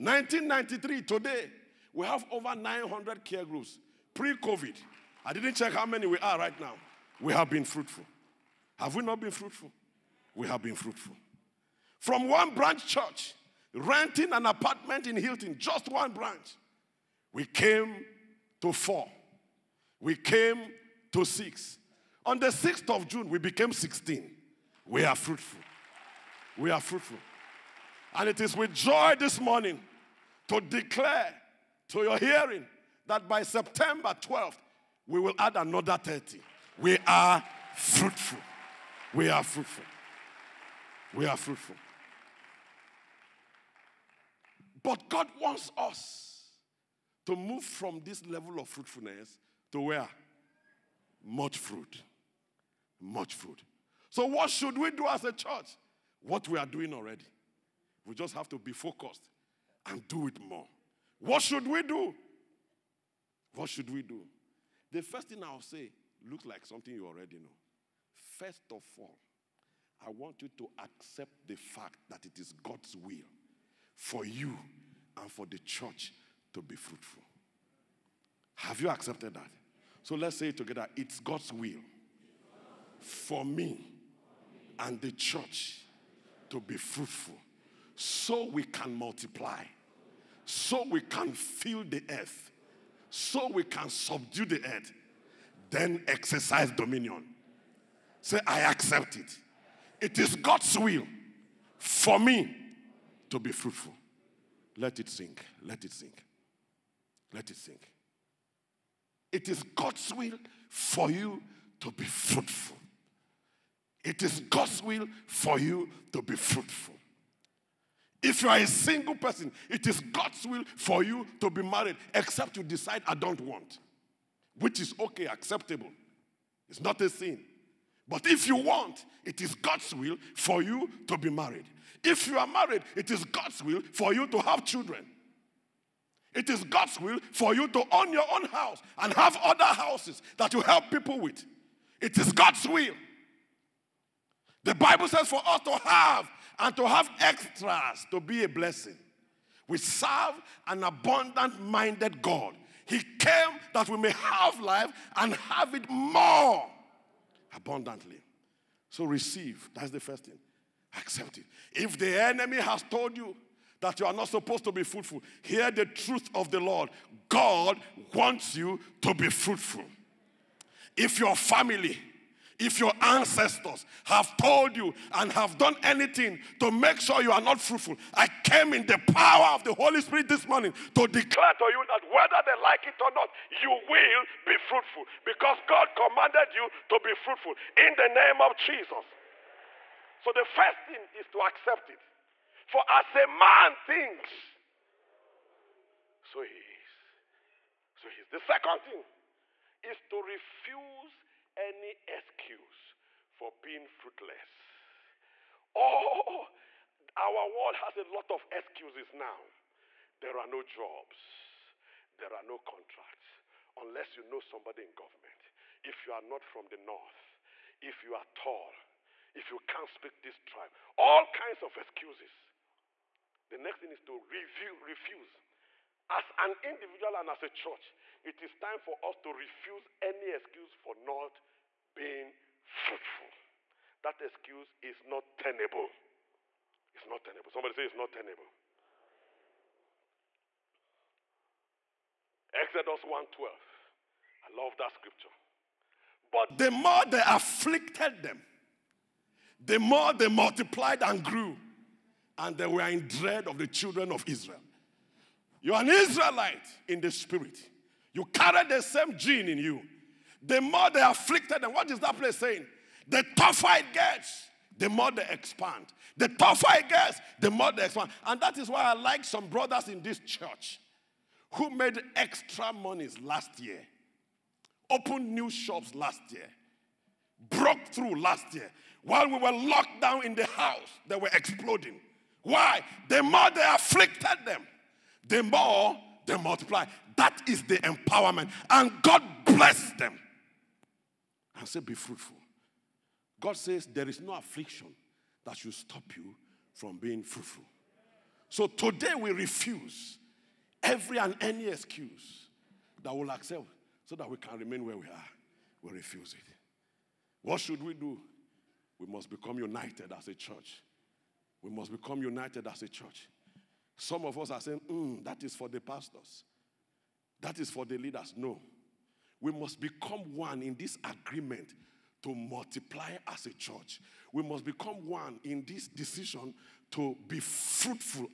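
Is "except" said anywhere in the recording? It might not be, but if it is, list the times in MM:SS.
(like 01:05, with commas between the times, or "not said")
02:02.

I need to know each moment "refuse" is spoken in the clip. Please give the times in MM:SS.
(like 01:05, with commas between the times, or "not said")
03:20, 03:44, 03:49, 04:59, 05:05.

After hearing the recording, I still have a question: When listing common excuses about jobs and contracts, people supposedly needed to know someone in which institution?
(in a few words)
government.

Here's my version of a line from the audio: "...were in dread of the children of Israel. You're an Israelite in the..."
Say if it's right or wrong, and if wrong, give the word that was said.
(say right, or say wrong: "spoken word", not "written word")
right.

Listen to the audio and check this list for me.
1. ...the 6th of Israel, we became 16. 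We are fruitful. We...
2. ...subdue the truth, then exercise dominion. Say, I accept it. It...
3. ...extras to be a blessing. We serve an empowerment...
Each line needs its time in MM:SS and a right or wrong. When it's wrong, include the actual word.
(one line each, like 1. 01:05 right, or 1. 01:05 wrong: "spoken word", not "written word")
1. 00:22 wrong: "June", not "Israel"
2. 01:33 wrong: "earth", not "truth"
3. 02:27 wrong: "abundant", not "empowerment".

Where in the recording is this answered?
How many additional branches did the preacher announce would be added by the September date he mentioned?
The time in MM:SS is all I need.
00:35.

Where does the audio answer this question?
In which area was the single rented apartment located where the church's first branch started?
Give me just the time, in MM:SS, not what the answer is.
00:15.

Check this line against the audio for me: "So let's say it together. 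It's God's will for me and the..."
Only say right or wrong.
right.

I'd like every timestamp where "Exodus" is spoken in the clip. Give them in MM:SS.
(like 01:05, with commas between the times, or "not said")
04:02.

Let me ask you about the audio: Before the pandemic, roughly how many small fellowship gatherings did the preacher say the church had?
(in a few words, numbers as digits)
over 900.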